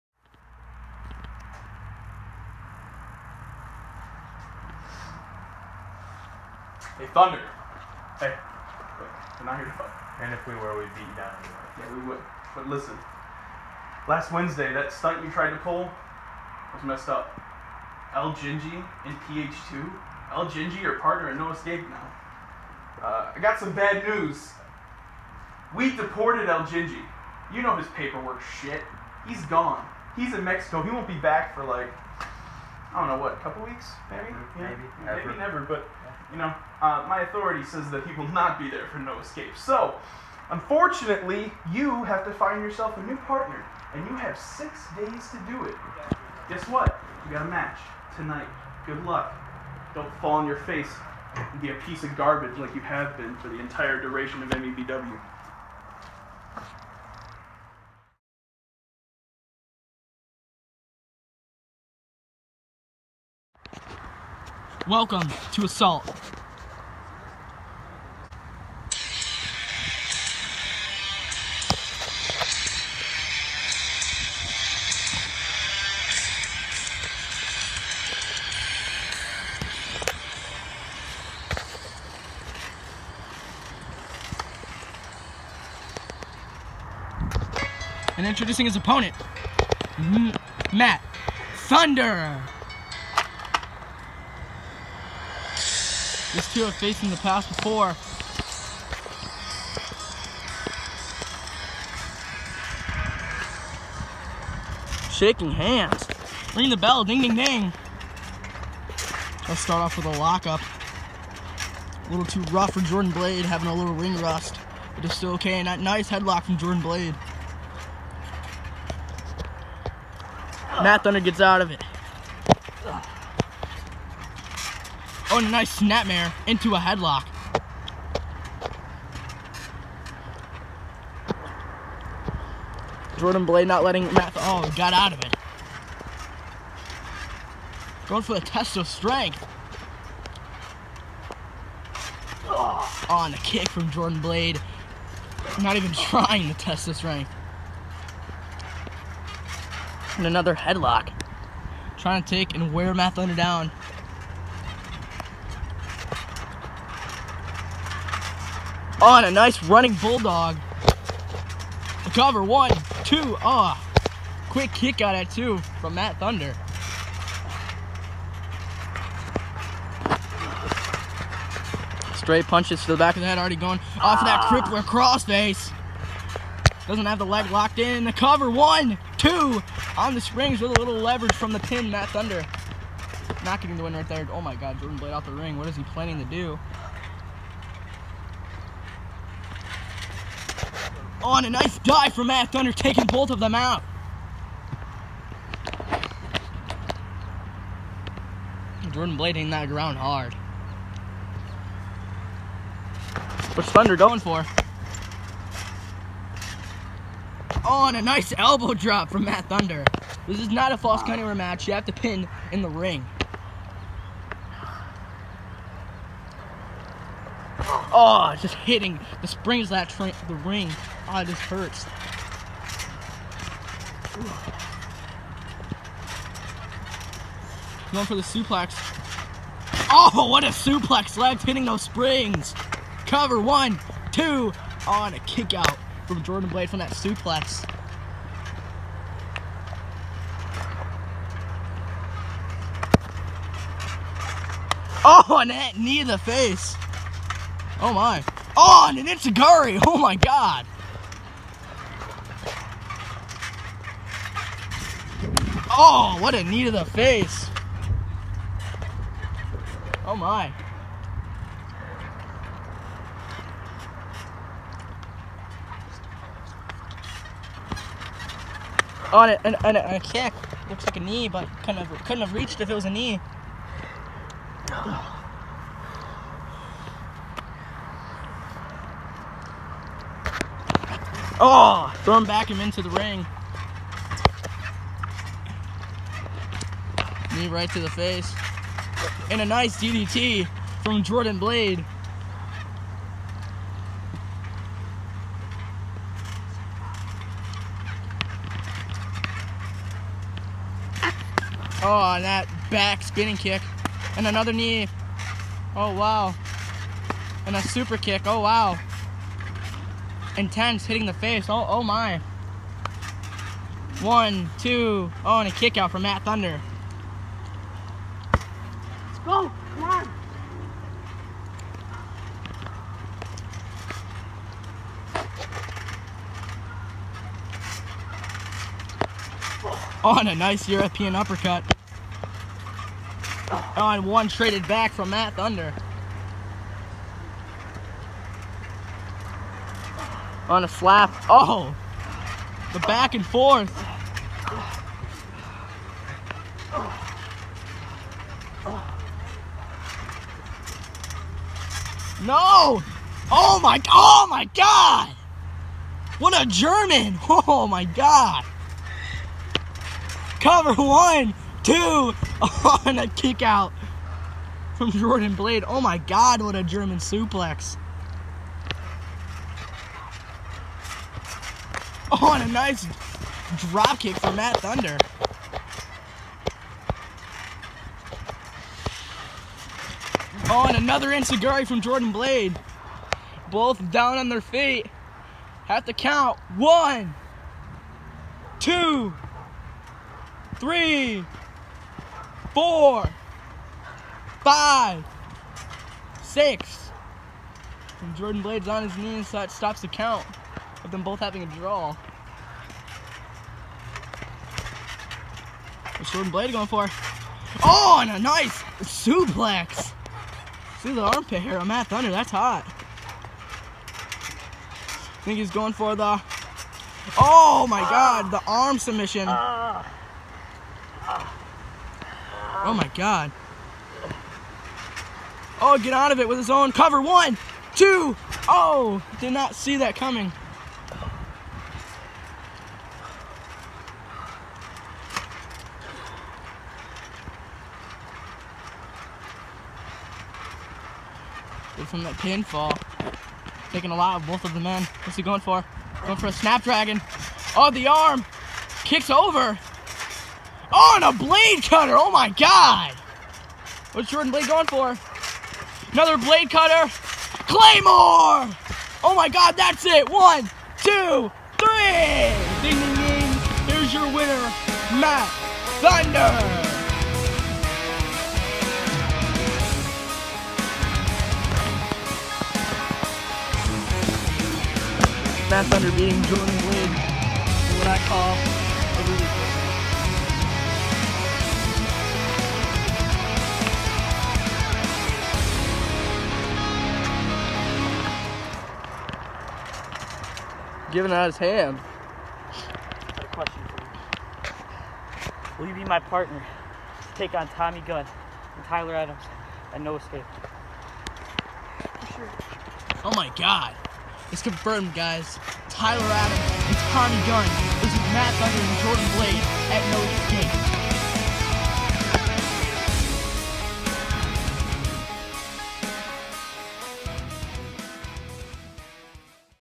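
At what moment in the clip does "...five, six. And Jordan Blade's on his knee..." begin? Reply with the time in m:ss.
6:34.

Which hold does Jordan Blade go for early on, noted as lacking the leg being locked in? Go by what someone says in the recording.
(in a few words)
crippler crossface.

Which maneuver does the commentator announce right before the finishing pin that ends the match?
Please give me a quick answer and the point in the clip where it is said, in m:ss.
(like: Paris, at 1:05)
Claymore, at 7:37.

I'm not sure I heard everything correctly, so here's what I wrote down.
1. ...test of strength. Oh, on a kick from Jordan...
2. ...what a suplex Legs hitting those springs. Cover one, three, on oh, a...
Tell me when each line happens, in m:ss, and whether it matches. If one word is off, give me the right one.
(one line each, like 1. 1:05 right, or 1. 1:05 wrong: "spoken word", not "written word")
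1. 2:18 right
2. 3:50 wrong: "two", not "three".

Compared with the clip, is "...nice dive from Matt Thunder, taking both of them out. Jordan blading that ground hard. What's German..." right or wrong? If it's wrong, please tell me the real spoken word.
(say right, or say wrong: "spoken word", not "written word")
wrong: "Thunder", not "German".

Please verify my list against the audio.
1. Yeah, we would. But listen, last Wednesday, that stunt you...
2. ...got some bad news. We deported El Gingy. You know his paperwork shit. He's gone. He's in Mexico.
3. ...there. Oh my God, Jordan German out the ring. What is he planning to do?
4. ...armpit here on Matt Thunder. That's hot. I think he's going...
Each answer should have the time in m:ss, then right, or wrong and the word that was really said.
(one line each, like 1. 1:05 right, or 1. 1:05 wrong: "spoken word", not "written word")
1. 0:11 right
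2. 0:23 right
3. 3:04 wrong: "Blade", not "German"
4. 6:51 right.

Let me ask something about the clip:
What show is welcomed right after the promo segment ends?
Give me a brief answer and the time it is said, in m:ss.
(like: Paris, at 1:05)
Assault, at 1:05.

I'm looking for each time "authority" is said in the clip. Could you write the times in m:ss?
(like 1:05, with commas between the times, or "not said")
0:37.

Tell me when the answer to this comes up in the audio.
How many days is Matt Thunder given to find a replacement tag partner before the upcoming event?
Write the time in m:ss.
0:44.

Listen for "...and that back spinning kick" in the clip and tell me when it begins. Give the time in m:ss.
5:02.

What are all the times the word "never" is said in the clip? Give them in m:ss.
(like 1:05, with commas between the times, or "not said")
0:35.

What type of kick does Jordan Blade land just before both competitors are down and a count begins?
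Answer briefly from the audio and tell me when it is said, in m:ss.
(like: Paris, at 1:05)
Enzuigiri, at 6:21.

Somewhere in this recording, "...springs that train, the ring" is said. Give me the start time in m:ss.
3:39.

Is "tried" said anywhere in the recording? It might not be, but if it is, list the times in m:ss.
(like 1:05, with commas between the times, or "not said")
0:15.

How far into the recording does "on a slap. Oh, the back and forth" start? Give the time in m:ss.
5:40.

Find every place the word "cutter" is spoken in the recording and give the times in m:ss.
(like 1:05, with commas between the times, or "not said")
7:31, 7:36.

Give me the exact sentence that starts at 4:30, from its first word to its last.
Looks like a knee, but couldn't have, couldn't have reached if it was a knee.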